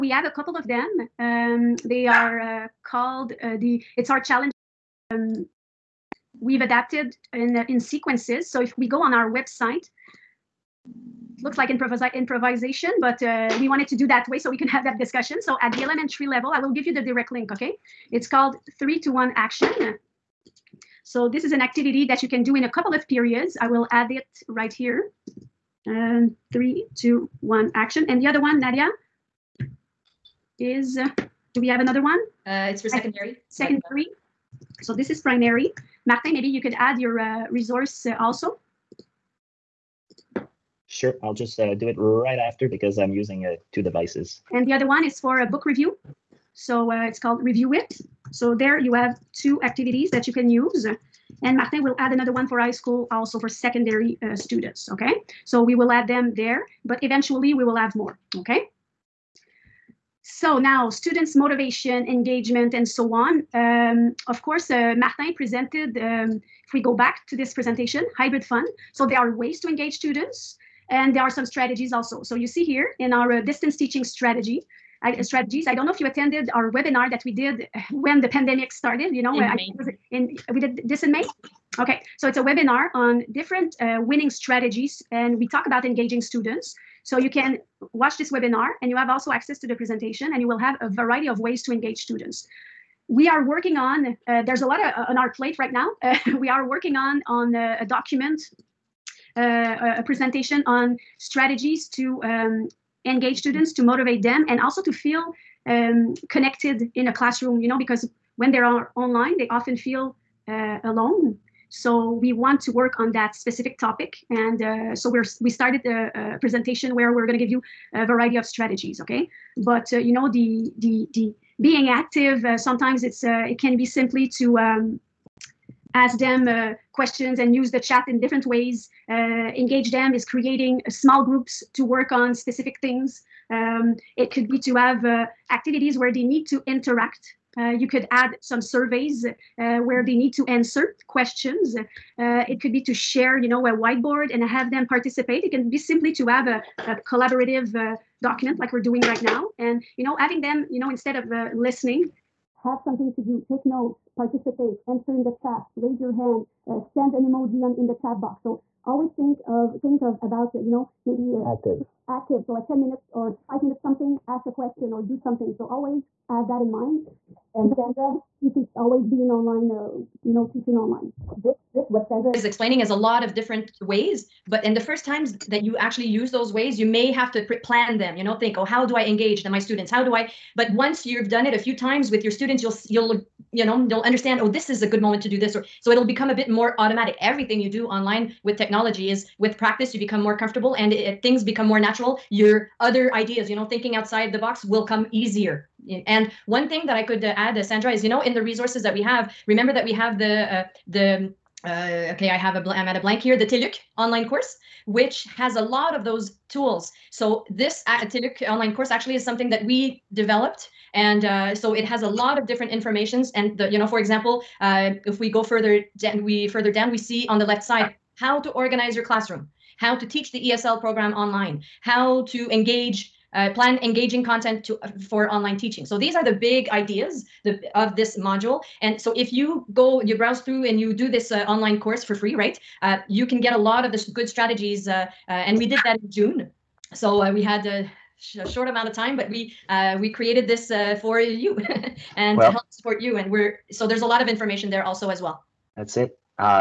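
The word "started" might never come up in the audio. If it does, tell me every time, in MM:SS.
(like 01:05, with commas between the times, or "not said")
01:18, 01:55.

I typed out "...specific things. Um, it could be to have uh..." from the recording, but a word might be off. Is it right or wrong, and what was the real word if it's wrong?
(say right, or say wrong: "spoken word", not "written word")
right.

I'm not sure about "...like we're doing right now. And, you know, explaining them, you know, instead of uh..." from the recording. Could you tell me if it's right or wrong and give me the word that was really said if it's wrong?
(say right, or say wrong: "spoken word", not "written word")
wrong: "having", not "explaining".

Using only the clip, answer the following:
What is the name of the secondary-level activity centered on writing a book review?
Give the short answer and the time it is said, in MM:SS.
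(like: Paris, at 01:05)
Review It, at 00:47.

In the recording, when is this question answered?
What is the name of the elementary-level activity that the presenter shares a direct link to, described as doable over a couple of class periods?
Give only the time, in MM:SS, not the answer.
00:18.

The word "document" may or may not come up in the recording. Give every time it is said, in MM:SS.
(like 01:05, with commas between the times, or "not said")
01:37, 02:28.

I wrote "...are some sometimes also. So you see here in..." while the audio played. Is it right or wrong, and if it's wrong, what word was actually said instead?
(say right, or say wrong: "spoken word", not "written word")
wrong: "strategies", not "sometimes".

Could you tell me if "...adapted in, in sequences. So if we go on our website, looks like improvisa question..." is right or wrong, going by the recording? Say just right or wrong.
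wrong.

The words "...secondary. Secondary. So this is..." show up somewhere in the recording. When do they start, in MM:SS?
00:32.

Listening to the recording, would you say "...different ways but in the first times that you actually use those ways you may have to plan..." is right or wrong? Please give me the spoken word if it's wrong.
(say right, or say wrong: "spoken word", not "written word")
right.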